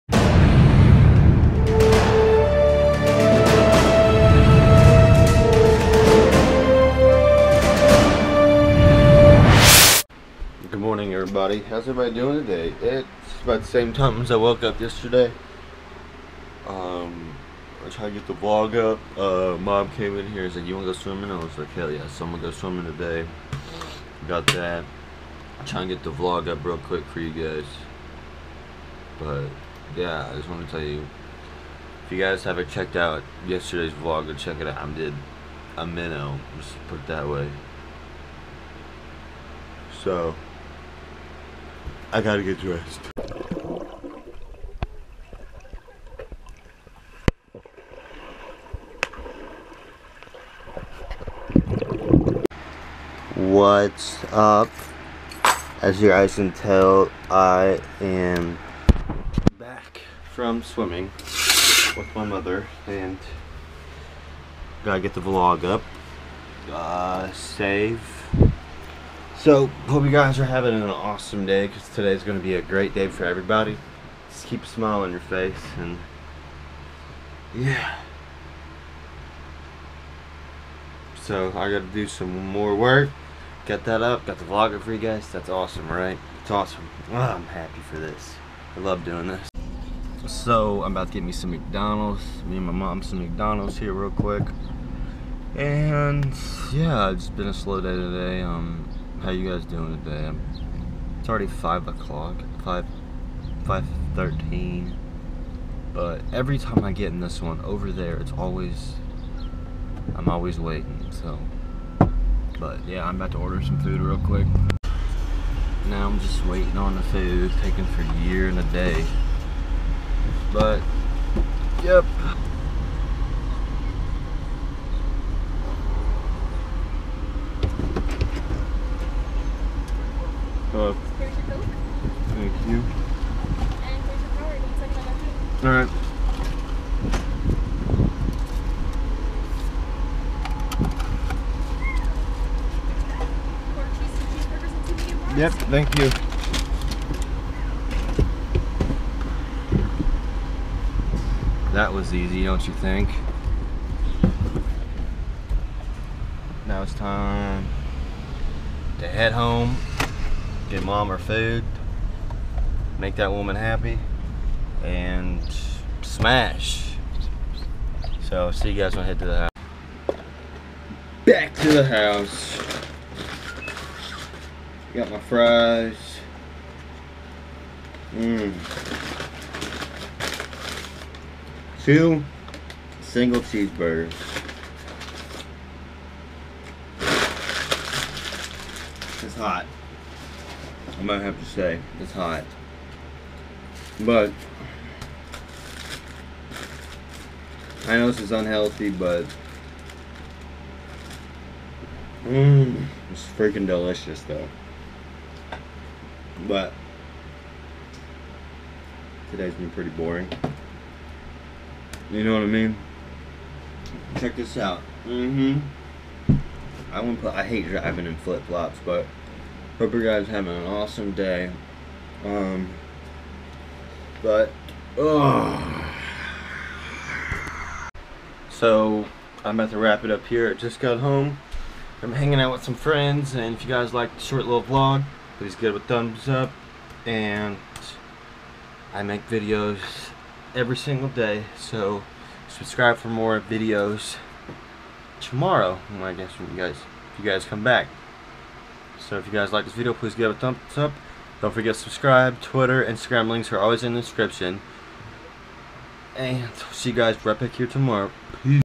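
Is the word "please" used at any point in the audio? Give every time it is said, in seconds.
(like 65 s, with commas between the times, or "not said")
235 s, 249 s.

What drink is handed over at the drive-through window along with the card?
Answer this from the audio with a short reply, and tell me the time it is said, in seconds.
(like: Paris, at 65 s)
Coke, at 131 s.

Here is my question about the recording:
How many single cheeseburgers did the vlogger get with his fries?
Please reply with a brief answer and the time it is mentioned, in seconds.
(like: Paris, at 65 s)
2, at 181 s.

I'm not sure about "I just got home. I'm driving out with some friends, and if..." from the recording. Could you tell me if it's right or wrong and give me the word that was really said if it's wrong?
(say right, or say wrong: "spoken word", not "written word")
wrong: "hanging", not "driving".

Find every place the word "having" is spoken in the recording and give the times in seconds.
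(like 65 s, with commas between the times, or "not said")
70 s, 220 s.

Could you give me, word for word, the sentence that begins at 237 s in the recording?
And I make videos every single day, so subscribe for more videos tomorrow.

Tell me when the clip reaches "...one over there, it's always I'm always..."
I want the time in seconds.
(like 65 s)
107 s.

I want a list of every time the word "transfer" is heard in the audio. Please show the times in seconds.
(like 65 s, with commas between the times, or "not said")
not said.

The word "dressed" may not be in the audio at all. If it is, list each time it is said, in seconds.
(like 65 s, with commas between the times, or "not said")
42 s.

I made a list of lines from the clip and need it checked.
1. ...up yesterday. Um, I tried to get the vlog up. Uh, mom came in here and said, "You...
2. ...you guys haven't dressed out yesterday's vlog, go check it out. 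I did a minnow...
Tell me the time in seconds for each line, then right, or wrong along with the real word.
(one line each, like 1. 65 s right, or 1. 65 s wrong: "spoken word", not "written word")
1. 14 s right
2. 32 s wrong: "checked", not "dressed".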